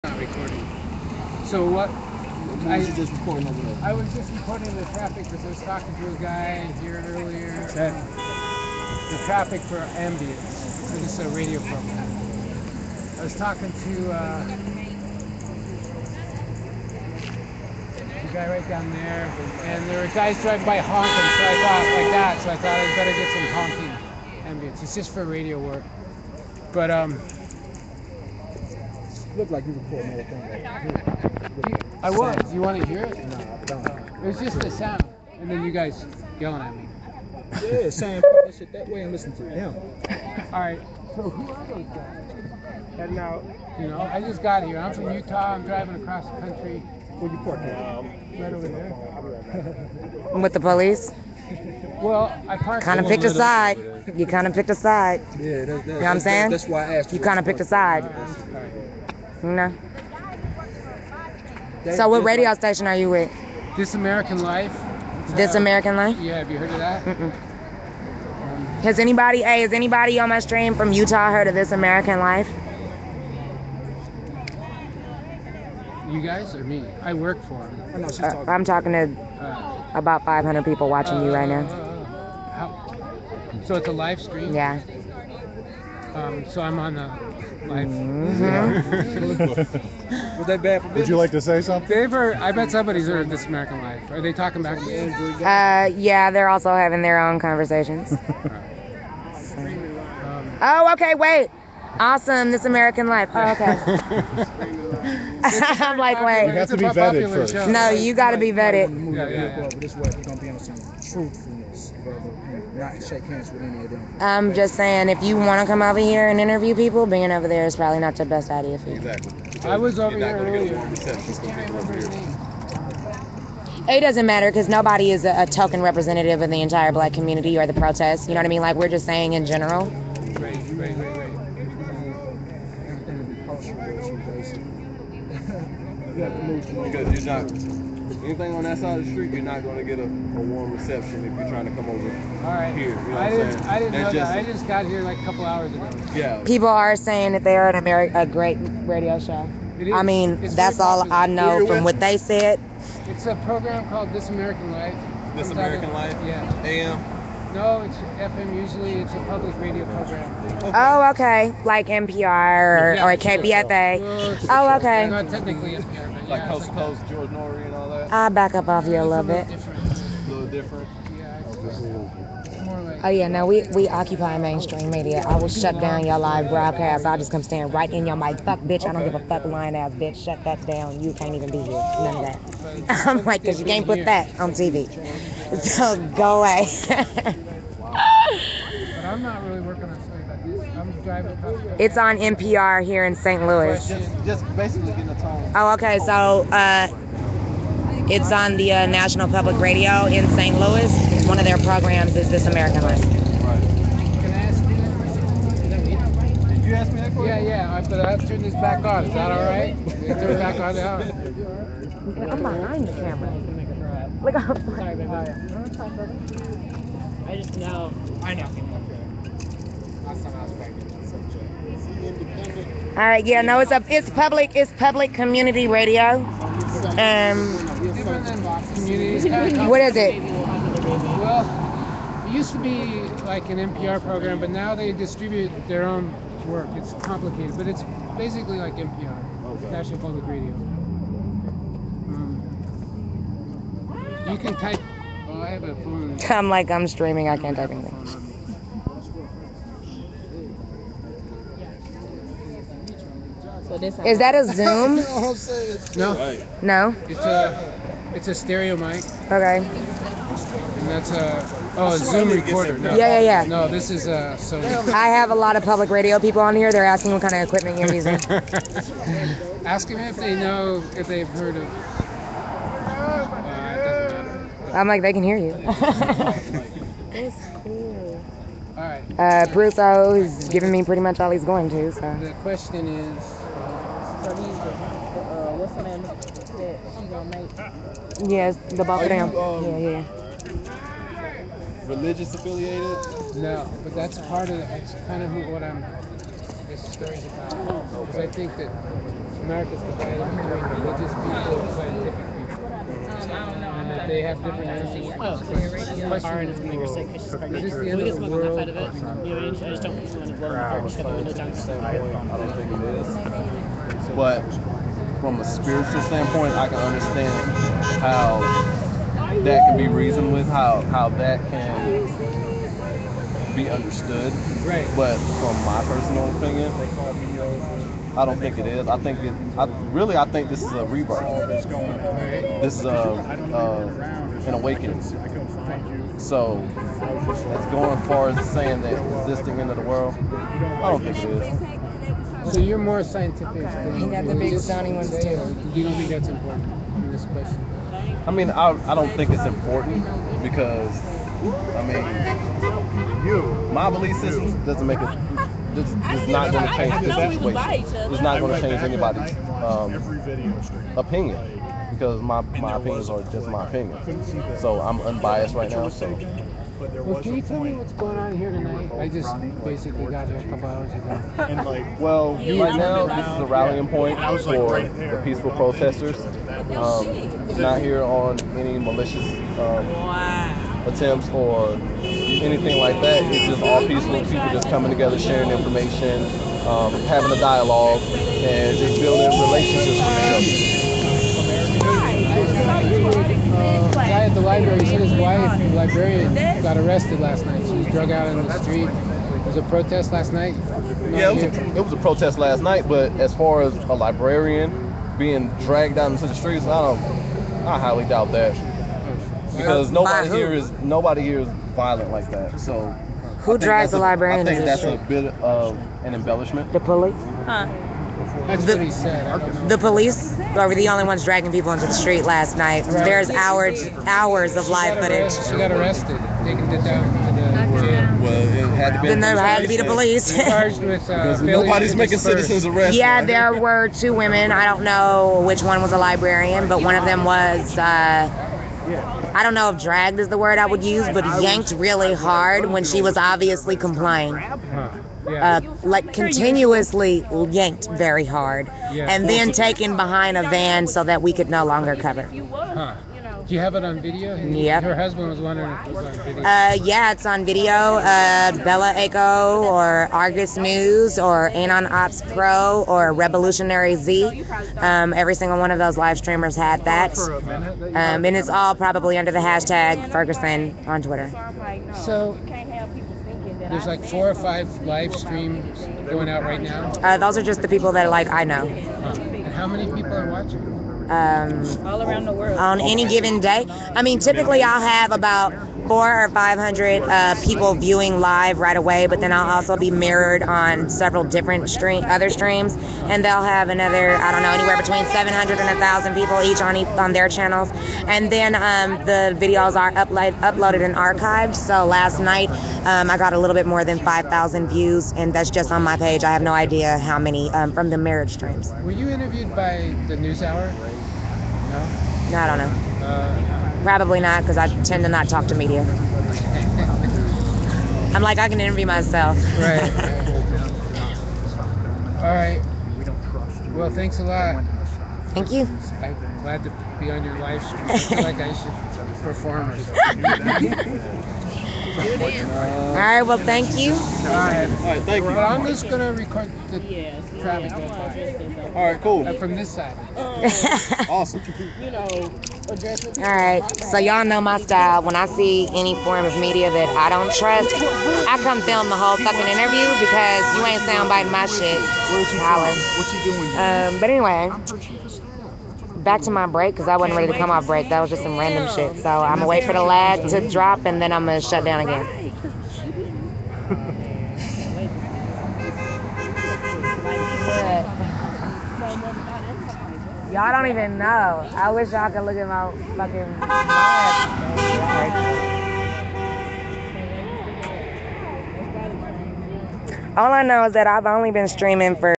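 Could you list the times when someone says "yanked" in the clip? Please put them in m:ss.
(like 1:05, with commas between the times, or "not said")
7:21, 7:27.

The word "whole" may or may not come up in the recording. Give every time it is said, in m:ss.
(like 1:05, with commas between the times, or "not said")
0:30, 9:08.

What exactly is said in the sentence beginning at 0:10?
So this is a radio program.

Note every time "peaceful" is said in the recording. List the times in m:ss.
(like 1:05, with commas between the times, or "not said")
6:15, 6:23.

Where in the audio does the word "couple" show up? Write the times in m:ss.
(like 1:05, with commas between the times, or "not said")
2:25, 6:10.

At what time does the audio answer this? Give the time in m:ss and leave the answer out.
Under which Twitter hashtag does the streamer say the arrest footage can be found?
7:49.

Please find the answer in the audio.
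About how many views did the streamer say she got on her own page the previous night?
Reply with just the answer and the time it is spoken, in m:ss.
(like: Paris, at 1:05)
5,000, at 8:23.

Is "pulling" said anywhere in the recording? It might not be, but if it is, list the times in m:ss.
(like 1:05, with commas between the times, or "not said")
0:29.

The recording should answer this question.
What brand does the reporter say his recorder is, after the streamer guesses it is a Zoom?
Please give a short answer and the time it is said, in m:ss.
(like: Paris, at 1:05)
Sony, at 4:24.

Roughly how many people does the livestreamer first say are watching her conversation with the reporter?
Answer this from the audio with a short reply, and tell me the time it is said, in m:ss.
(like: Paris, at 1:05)
500, at 1:19.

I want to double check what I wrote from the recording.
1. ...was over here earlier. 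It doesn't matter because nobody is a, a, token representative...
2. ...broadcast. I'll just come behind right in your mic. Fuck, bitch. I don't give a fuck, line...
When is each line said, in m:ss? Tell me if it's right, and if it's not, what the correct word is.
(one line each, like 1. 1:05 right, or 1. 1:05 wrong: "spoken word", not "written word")
1. 1:59 right
2. 2:56 wrong: "stand", not "behind".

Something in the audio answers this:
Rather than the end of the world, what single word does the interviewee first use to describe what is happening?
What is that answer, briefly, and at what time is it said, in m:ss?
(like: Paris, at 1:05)
rebirth, at 5:30.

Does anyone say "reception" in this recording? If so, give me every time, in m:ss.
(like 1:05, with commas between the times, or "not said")
2:20.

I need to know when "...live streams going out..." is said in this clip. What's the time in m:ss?
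7:54.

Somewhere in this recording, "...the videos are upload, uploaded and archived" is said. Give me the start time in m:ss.
8:19.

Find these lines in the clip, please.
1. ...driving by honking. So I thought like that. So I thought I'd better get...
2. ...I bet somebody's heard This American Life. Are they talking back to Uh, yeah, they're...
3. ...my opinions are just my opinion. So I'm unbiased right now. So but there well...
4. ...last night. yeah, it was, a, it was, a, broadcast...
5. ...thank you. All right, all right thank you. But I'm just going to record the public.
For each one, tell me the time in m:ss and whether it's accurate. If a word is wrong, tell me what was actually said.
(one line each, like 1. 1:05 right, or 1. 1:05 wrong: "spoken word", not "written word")
1. 0:20 right
2. 1:32 right
3. 6:02 right
4. 6:40 wrong: "protest", not "broadcast"
5. 8:53 wrong: "traffic", not "public".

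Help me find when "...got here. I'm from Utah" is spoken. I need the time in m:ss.
0:44.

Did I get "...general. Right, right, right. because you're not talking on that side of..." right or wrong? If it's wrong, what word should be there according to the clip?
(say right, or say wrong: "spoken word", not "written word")
wrong: "anything", not "talking".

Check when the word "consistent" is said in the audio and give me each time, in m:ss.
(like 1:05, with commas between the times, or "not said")
not said.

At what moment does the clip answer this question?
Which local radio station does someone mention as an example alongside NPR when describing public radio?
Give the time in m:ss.
2:43.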